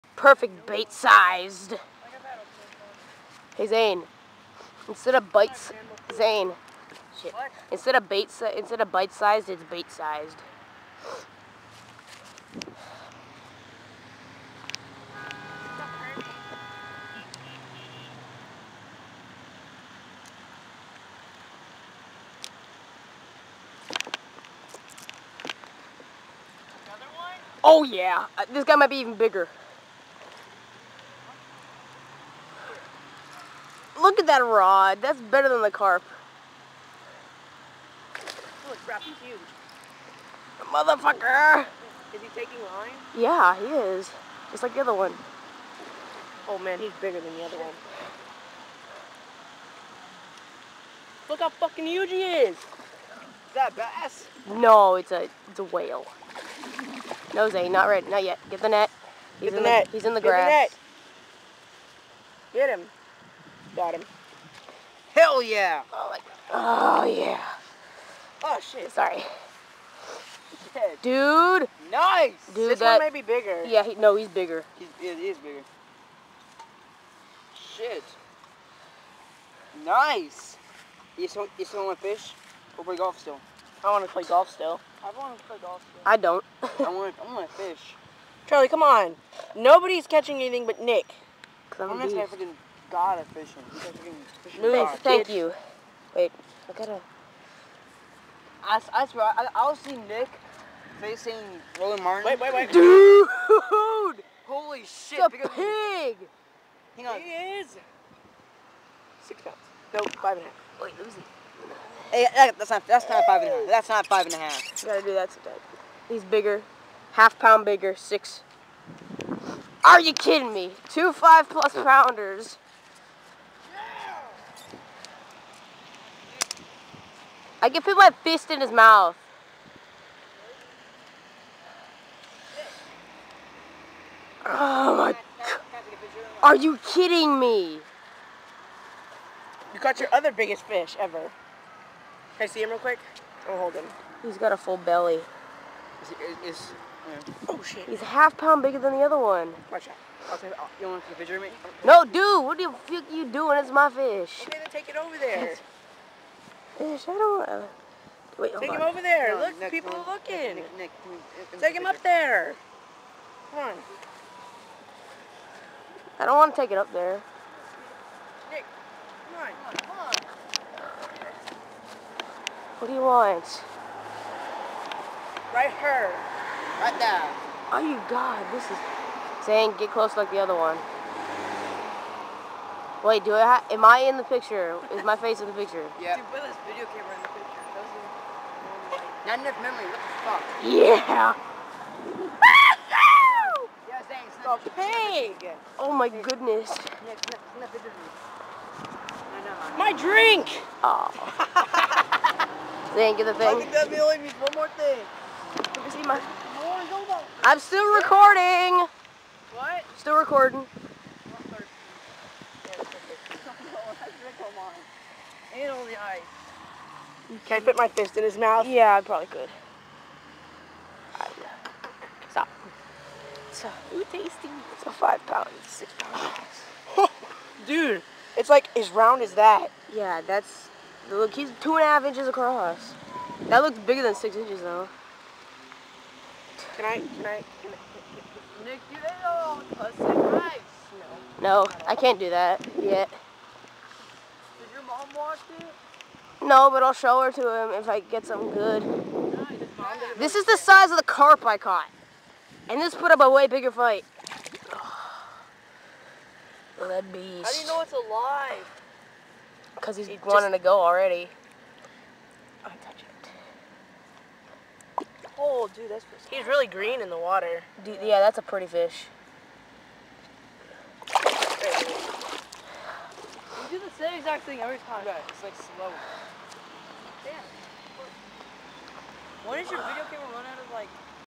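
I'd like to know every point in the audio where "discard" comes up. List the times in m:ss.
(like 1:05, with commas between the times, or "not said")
not said.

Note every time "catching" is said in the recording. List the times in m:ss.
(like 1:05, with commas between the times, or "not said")
1:30.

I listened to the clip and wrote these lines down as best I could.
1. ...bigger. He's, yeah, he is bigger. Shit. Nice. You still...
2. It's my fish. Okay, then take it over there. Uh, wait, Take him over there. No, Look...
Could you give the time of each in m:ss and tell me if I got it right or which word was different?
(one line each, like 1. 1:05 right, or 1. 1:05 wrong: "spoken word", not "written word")
1. 1:14 right
2. 2:33 right.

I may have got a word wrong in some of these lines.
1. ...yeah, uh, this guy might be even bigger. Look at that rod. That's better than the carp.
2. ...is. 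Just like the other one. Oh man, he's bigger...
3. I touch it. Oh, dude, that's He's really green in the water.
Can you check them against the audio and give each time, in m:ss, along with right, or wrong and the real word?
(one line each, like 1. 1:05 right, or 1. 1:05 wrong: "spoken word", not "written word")
1. 0:27 right
2. 0:43 right
3. 4:22 right.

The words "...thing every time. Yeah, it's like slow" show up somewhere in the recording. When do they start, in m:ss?
4:34.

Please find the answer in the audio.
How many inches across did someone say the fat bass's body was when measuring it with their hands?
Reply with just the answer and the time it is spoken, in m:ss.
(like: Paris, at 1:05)
2.5, at 3:51.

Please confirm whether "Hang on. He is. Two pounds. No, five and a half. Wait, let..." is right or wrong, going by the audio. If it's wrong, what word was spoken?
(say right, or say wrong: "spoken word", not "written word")
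wrong: "Six", not "Two".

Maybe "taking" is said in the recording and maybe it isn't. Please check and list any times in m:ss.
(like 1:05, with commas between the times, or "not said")
0:42.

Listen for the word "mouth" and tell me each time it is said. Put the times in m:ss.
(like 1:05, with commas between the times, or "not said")
2:08, 3:38.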